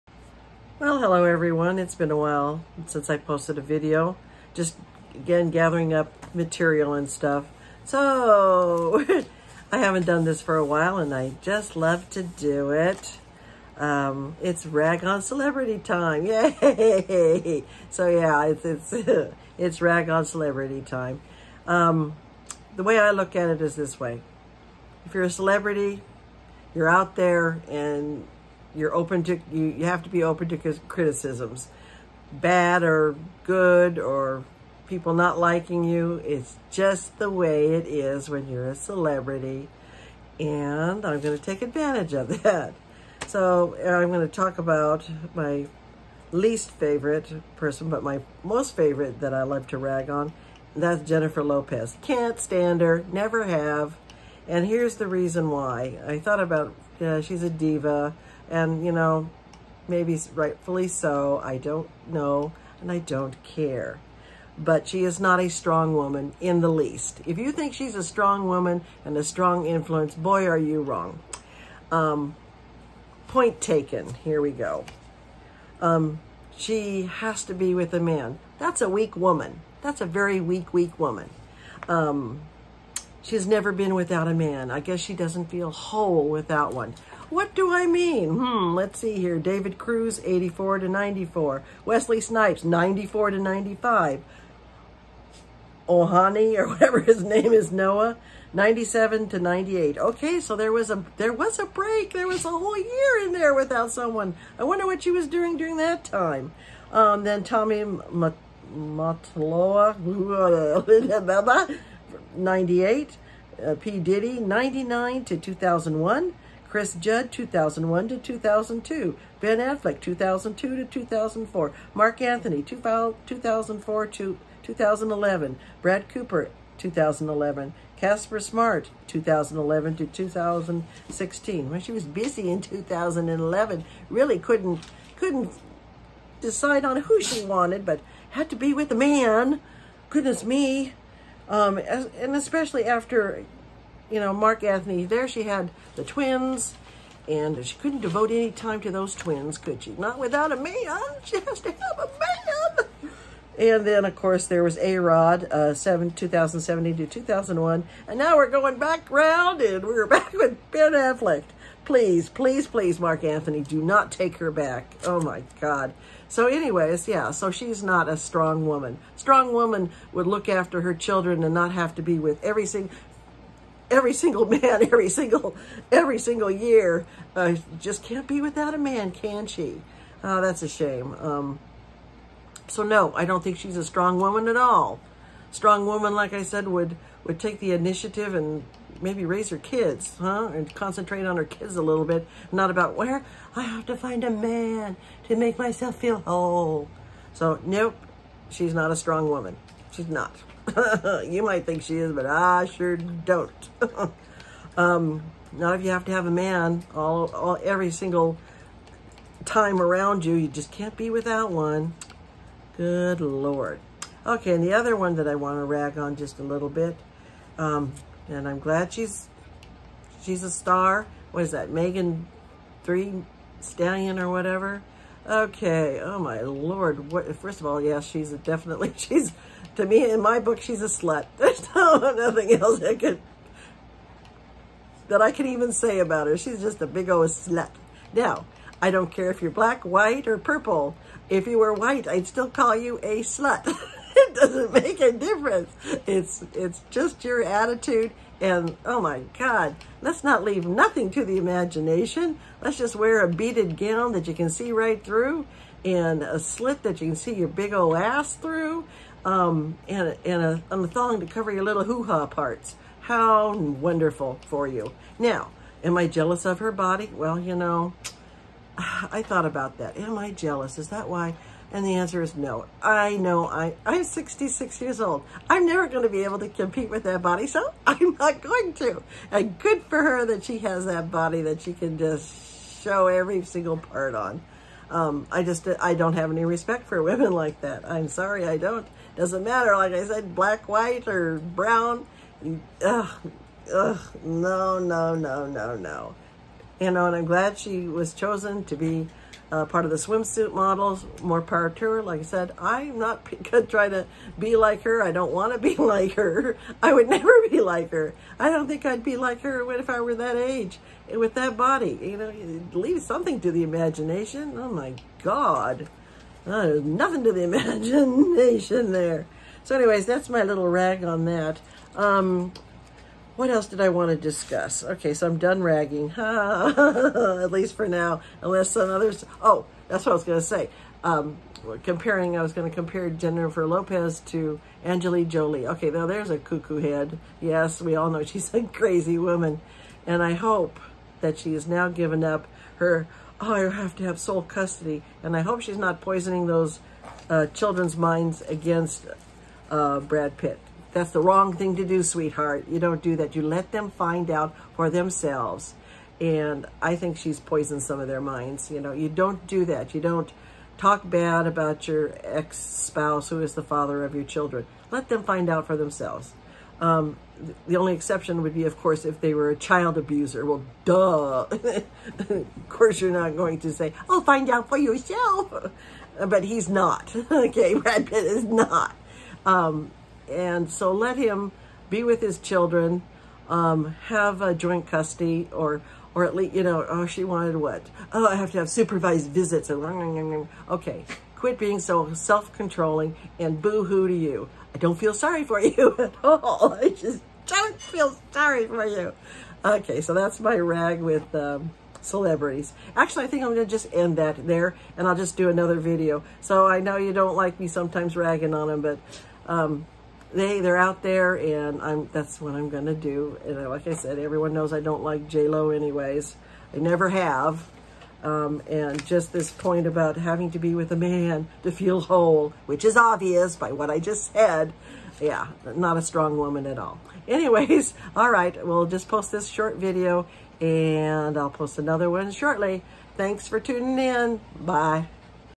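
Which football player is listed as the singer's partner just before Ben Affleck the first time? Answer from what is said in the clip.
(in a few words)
Chris Judd.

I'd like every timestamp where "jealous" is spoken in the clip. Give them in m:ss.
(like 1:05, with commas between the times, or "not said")
4:26, 4:30.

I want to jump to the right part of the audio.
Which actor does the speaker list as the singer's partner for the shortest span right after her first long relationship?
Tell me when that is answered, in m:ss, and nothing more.
1:31.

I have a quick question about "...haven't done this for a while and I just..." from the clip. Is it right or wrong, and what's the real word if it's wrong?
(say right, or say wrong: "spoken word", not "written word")
right.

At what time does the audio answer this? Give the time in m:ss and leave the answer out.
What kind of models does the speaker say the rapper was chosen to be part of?
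4:59.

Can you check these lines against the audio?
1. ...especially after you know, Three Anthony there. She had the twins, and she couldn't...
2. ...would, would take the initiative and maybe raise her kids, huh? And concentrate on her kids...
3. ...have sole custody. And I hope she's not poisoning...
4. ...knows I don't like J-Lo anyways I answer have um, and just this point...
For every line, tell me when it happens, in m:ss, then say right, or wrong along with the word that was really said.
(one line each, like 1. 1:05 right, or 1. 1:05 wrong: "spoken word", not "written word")
1. 2:22 wrong: "Marc", not "Three"
2. 3:06 right
3. 5:44 right
4. 6:54 wrong: "never", not "answer".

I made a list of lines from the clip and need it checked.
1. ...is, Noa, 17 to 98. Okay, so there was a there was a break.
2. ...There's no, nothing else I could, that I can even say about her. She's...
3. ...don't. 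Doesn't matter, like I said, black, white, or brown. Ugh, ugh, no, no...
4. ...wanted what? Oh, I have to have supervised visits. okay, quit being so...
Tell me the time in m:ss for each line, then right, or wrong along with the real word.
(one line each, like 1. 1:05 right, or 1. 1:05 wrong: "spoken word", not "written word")
1. 1:37 wrong: "97", not "17"
2. 3:51 right
3. 4:48 right
4. 6:27 right.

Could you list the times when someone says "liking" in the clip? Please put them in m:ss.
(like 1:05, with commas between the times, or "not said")
0:35.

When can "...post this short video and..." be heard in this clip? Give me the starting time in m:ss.
7:09.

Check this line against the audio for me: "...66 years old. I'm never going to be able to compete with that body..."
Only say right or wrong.
right.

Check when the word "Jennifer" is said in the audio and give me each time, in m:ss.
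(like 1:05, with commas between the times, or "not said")
0:51, 5:33.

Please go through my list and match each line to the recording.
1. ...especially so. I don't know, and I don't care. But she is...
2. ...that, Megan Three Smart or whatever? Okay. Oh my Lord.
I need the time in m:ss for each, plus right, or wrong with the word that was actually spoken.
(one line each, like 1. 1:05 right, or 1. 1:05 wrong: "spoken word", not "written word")
1. 1:00 wrong: "rightfully", not "especially"
2. 3:41 wrong: "Stallion", not "Smart".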